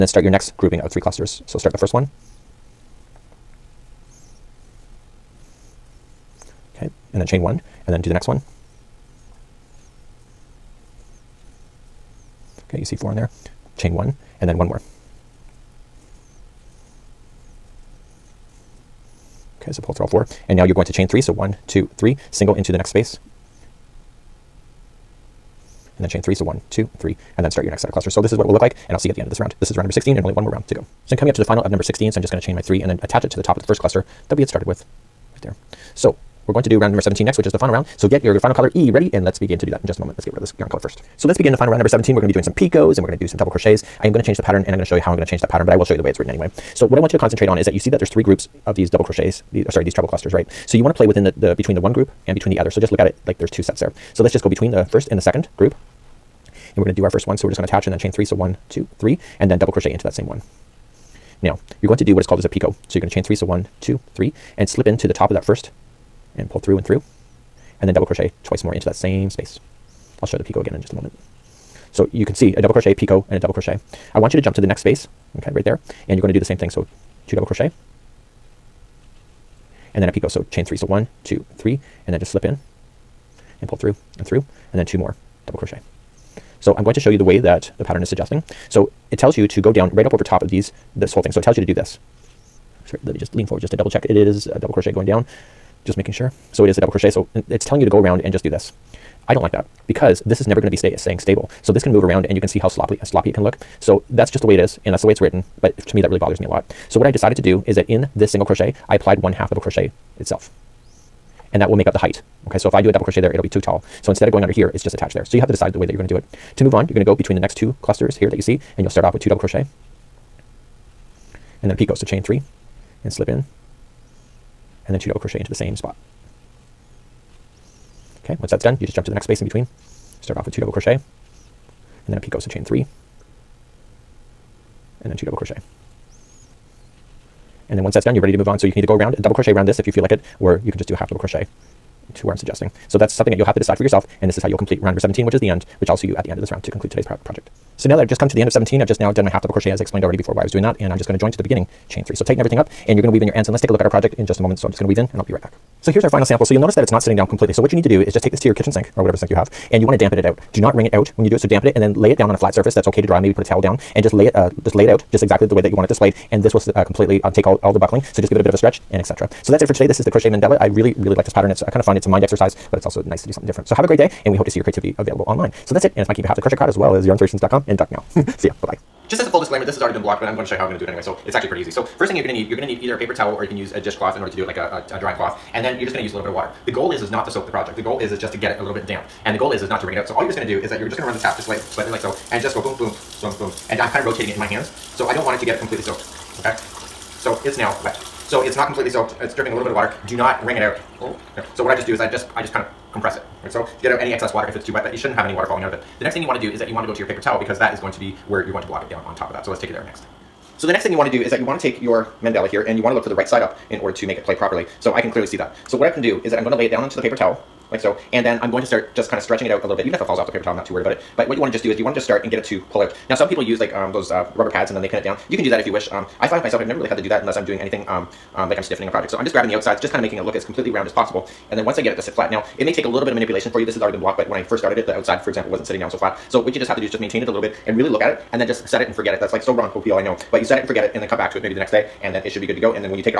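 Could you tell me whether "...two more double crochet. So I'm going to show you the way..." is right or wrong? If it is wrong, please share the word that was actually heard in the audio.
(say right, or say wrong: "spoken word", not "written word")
right.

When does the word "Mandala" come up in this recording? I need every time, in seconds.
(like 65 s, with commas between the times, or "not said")
170 s, 212 s.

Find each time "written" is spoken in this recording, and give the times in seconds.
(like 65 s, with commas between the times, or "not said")
46 s, 105 s.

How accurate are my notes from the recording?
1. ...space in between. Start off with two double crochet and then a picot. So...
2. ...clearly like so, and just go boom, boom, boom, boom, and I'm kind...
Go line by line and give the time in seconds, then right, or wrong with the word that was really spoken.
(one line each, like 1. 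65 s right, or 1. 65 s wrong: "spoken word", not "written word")
1. 129 s right
2. 191 s wrong: "slightly", not "clearly".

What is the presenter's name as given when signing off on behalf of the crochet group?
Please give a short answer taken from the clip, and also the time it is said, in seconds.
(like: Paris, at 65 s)
Mikey, at 176 s.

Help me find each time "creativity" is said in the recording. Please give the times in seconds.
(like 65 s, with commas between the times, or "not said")
174 s.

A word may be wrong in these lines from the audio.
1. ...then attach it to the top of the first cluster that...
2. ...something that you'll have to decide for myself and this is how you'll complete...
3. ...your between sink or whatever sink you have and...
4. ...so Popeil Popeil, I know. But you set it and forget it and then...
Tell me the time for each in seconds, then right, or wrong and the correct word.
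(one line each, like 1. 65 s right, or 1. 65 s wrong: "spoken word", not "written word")
1. 32 s right
2. 143 s wrong: "yourself", not "myself"
3. 158 s wrong: "kitchen", not "between"
4. 239 s wrong: "Ron", not "Popeil".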